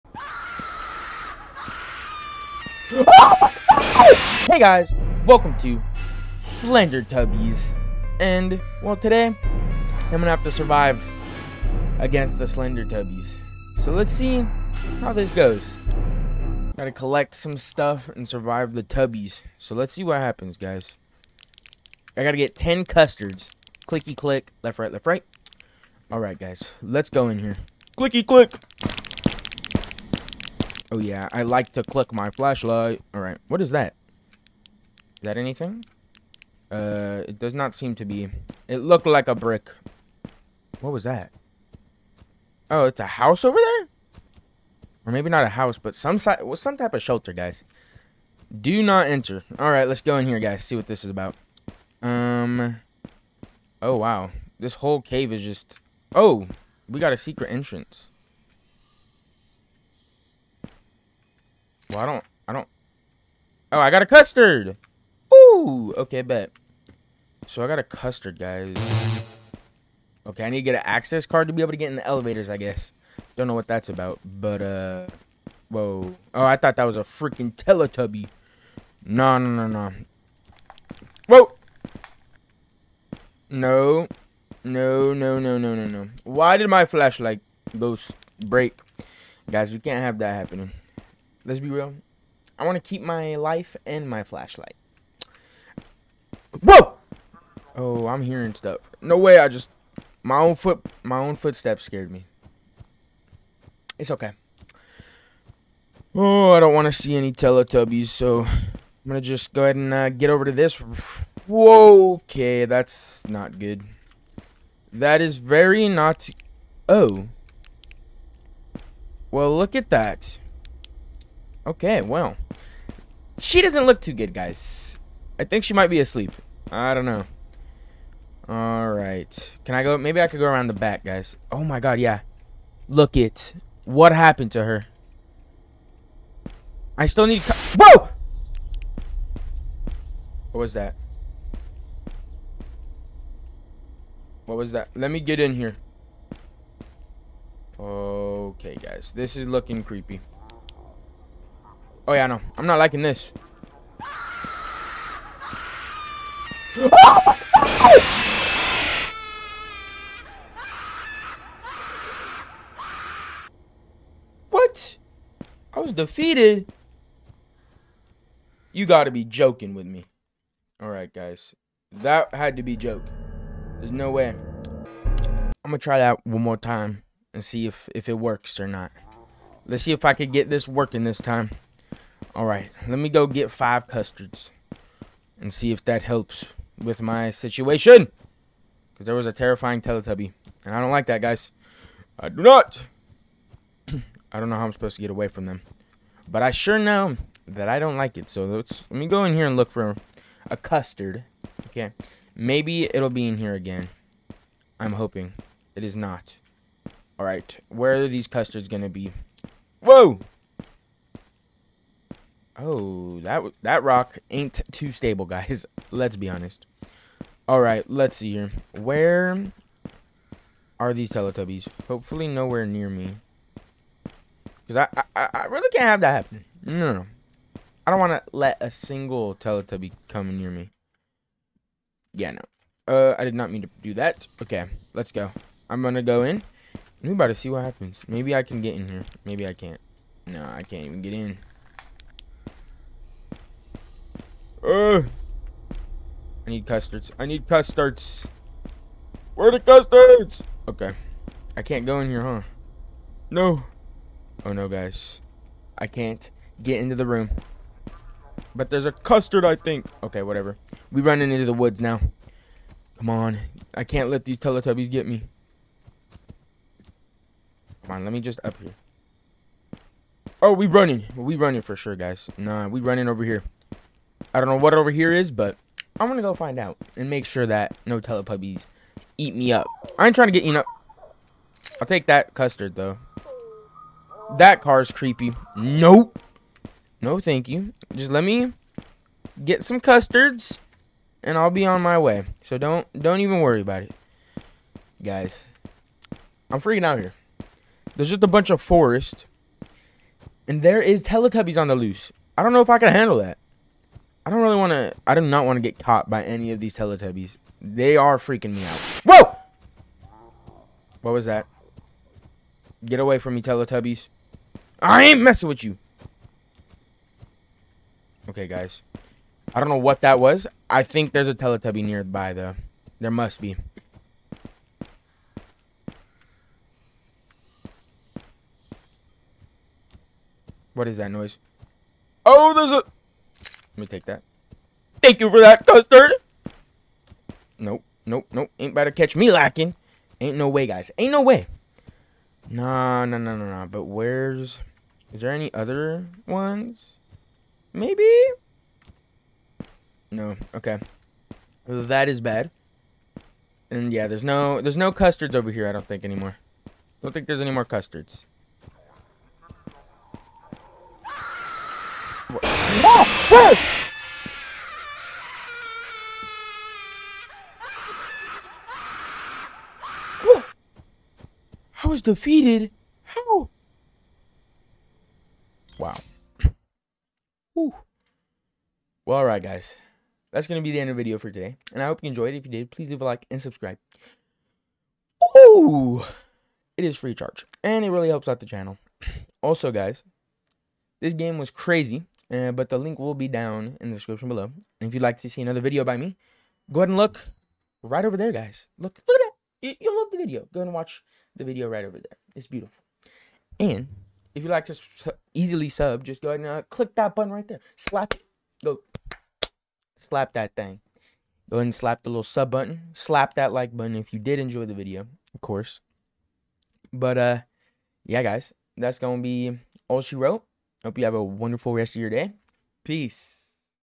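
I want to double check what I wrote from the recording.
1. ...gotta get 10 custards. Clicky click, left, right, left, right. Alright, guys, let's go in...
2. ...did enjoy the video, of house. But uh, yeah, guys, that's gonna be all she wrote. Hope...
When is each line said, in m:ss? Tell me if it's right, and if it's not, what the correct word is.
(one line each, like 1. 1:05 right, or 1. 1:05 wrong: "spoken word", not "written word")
1. 0:22 right
2. 6:54 wrong: "course", not "house".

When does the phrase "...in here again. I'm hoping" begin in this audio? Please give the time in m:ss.
3:23.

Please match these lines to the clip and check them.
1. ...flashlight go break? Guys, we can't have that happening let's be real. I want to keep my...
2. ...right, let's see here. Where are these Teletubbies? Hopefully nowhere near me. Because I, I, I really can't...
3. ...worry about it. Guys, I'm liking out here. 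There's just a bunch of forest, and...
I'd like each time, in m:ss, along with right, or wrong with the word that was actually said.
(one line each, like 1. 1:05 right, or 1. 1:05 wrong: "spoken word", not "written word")
1. 1:26 right
2. 3:37 right
3. 4:53 wrong: "freaking", not "liking".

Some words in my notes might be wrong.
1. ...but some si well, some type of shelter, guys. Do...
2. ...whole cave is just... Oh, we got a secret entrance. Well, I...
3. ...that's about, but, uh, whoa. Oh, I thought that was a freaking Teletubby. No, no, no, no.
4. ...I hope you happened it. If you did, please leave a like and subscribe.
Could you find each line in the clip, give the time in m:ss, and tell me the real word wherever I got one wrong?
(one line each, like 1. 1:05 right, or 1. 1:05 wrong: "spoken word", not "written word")
1. 0:45 right
2. 0:54 right
3. 1:13 right
4. 6:21 wrong: "enjoyed", not "happened".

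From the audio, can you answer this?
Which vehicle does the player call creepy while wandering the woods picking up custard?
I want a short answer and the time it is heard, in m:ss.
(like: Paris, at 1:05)
car, at 4:44.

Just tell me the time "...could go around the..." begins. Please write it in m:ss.
2:10.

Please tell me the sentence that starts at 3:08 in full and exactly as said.
Because there was a terrifying Teletubby.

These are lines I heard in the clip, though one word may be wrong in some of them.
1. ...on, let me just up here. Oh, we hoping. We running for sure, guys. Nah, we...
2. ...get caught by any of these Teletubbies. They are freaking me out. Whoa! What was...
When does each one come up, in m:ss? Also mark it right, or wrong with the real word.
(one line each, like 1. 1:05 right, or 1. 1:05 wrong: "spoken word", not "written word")
1. 4:27 wrong: "running", not "hoping"
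2. 5:05 right.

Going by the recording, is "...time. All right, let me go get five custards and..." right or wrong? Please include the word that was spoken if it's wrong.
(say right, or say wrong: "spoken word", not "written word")
right.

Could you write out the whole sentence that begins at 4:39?
I ain't trying to get eaten up.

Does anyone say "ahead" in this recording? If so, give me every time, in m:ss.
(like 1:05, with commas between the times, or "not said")
1:49, 6:36, 6:46, 6:51.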